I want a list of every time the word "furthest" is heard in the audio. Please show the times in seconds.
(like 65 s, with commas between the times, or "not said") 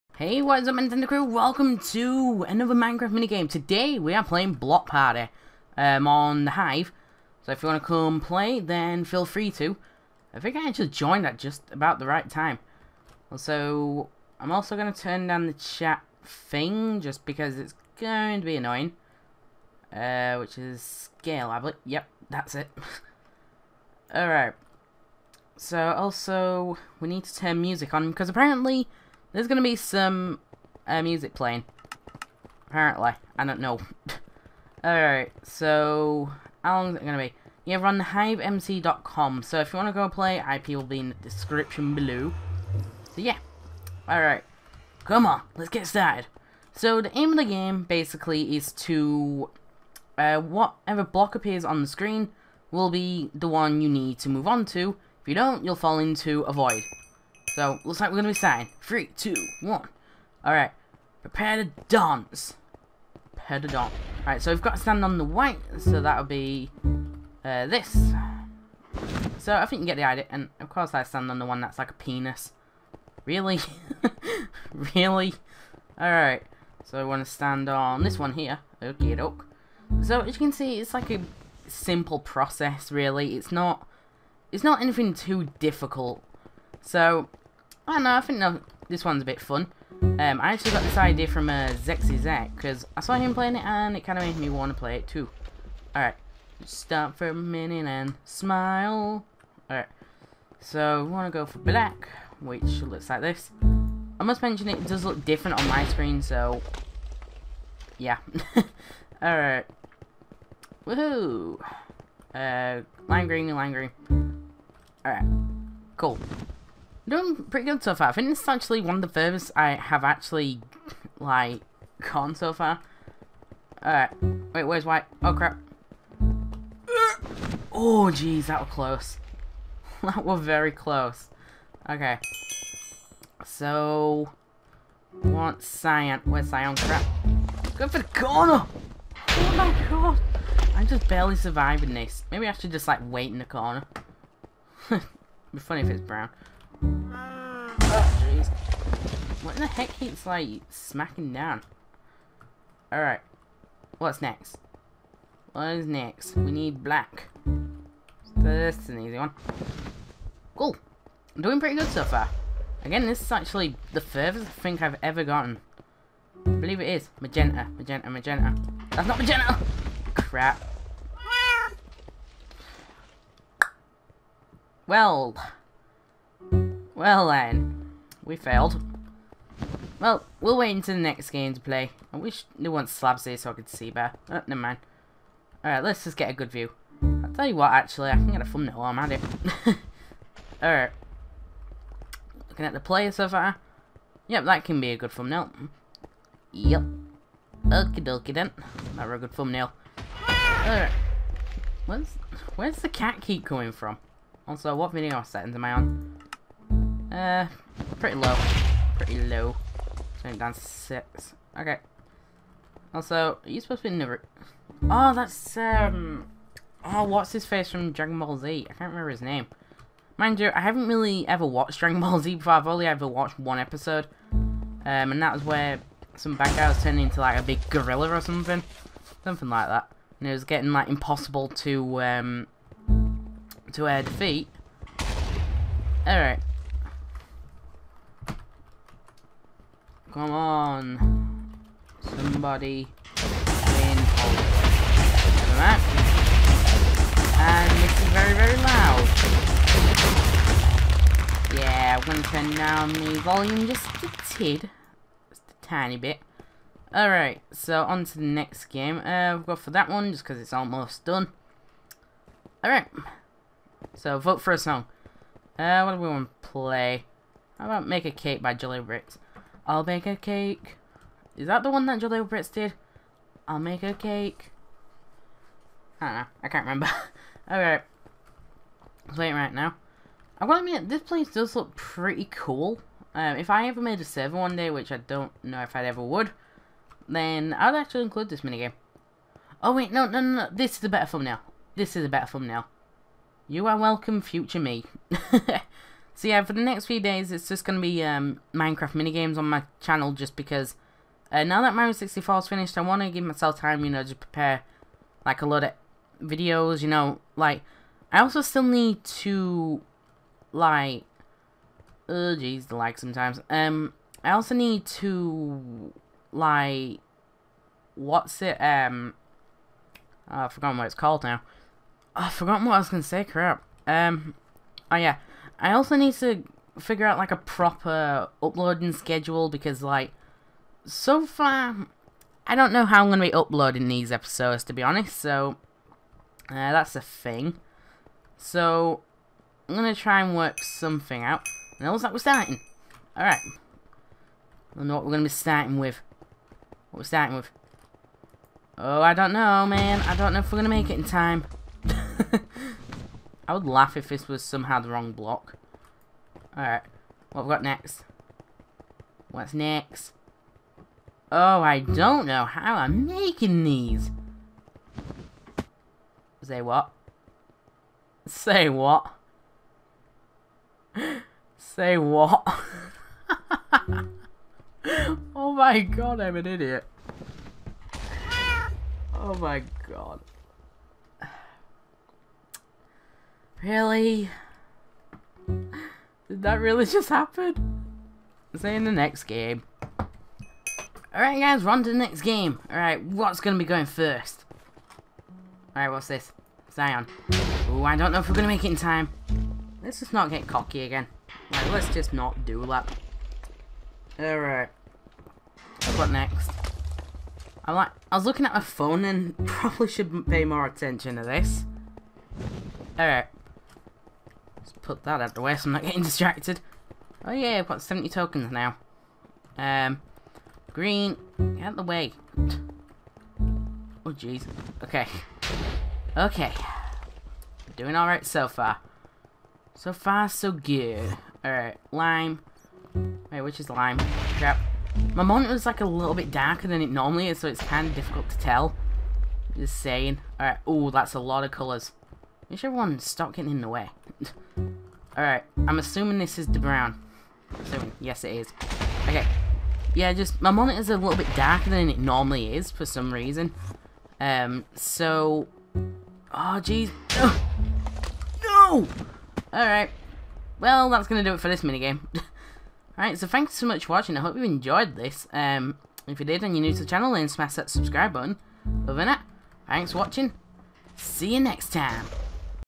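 119 s, 164 s.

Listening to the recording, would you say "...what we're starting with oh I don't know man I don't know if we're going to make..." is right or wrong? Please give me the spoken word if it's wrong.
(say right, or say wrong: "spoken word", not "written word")
right.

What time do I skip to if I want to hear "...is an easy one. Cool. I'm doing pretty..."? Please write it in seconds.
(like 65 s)
158 s.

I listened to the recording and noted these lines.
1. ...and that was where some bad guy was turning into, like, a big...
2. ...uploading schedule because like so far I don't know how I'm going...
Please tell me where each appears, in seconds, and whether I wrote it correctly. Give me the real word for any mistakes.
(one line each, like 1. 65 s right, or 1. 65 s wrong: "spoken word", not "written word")
1. 225 s right
2. 328 s right.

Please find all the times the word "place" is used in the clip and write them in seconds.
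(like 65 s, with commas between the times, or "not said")
281 s.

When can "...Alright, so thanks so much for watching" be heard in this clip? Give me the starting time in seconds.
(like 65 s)
462 s.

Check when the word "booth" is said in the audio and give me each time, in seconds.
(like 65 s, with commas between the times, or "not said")
not said.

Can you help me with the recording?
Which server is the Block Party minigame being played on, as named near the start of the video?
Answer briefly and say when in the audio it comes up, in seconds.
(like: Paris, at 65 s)
The Hive, at 6 s.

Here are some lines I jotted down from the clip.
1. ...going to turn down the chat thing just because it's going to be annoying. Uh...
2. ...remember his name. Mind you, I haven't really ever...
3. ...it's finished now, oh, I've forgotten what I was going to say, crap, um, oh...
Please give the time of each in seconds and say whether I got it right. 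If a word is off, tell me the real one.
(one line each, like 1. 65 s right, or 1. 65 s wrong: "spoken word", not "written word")
1. 14 s right
2. 218 s right
3. 320 s wrong: "called", not "finished".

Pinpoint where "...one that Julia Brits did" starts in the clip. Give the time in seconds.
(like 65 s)
271 s.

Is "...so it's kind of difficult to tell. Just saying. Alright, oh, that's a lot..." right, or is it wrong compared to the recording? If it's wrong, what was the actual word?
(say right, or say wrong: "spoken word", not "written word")
right.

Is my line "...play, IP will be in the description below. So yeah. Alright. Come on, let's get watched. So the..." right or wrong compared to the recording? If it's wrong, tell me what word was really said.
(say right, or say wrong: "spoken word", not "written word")
wrong: "started", not "watched".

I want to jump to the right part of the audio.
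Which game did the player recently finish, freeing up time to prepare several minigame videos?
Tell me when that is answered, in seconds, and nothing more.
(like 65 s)
301 s.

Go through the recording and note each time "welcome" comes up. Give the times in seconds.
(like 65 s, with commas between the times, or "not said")
1 s, 293 s.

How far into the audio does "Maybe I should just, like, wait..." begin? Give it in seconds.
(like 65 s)
142 s.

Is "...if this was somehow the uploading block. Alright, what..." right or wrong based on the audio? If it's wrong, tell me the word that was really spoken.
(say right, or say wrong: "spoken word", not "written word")
wrong: "wrong", not "uploading".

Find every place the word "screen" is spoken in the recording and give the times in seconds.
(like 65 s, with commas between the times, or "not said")
51 s, 105 s.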